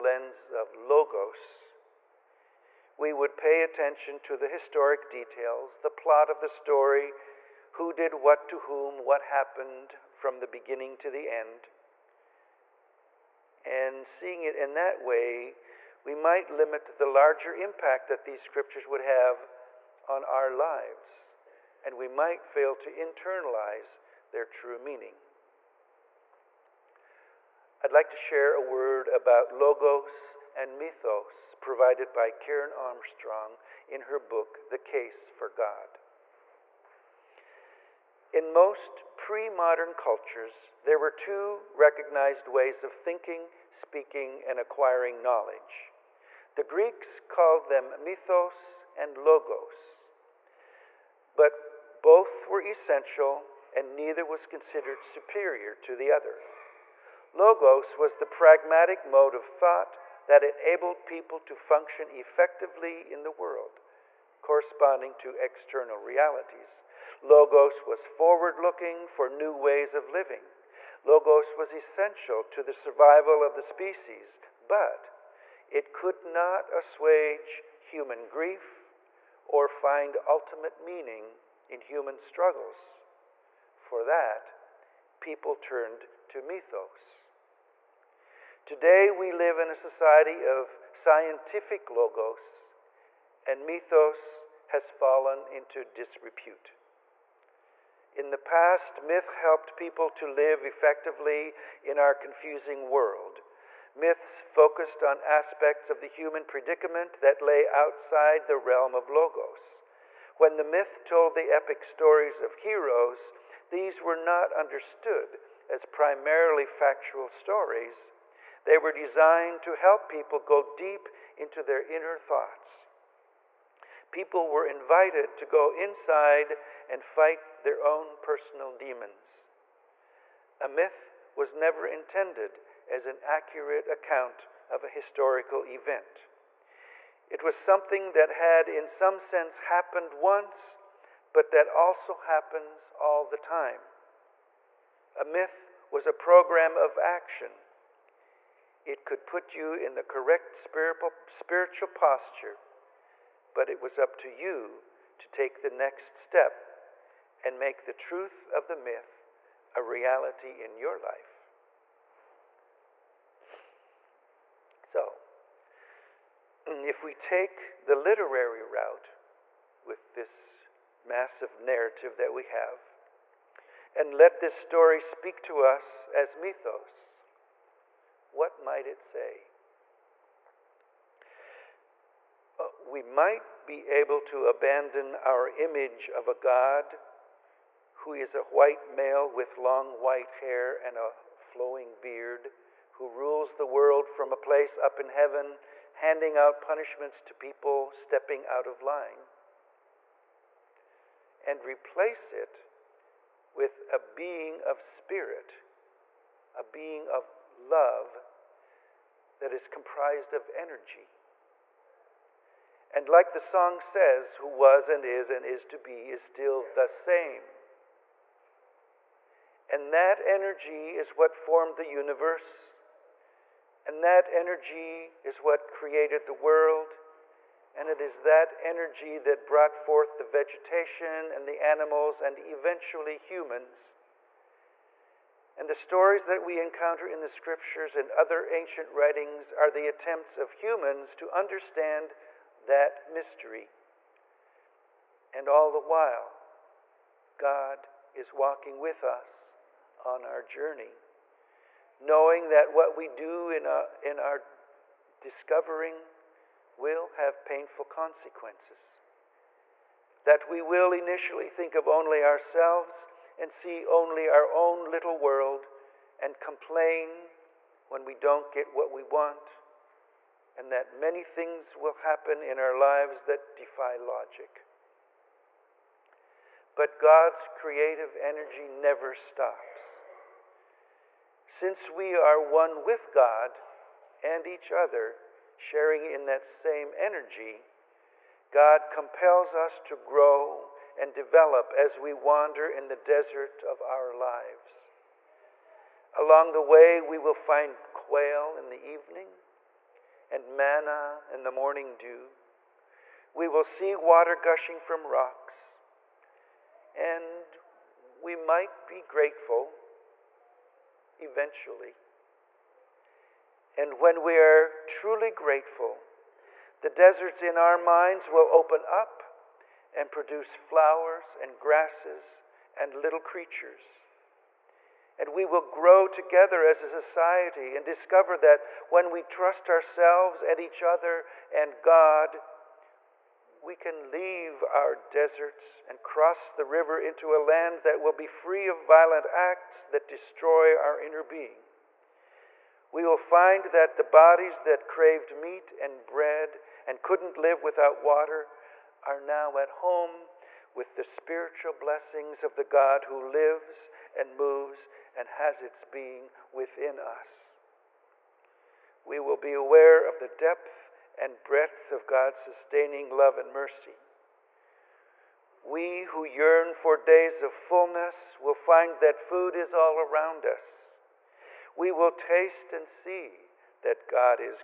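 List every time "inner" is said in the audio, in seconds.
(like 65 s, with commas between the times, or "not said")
121 s, 340 s.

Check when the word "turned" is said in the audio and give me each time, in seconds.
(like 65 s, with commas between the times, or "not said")
85 s.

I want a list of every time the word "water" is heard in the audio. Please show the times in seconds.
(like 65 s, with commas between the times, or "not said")
303 s, 347 s.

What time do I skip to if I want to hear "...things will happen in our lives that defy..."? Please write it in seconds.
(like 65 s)
271 s.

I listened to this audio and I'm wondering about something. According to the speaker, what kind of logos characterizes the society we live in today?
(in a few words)
Scientific logos.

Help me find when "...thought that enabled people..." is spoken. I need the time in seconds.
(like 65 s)
59 s.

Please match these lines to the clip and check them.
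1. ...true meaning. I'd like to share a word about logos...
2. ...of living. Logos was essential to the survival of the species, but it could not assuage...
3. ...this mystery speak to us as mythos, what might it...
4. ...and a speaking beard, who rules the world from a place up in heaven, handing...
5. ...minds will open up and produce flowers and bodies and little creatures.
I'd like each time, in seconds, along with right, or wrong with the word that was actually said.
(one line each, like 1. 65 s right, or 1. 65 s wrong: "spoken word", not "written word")
1. 24 s right
2. 69 s right
3. 174 s wrong: "story", not "mystery"
4. 190 s wrong: "flowing", not "speaking"
5. 317 s wrong: "grasses", not "bodies".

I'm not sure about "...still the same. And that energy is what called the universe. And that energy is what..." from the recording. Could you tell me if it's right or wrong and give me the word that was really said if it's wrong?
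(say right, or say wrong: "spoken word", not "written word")
wrong: "formed", not "called".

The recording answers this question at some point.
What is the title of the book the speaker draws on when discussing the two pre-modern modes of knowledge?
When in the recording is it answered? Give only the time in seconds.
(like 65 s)
34 s.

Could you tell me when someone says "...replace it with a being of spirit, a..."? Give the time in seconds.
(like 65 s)
201 s.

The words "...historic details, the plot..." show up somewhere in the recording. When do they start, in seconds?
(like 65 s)
4 s.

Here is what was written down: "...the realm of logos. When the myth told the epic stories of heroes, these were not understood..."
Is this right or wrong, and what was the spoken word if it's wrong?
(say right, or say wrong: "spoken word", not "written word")
right.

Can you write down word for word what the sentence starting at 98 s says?
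In the past, myth helped people to live effectively in our confusing world.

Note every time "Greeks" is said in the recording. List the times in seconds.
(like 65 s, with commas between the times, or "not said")
46 s.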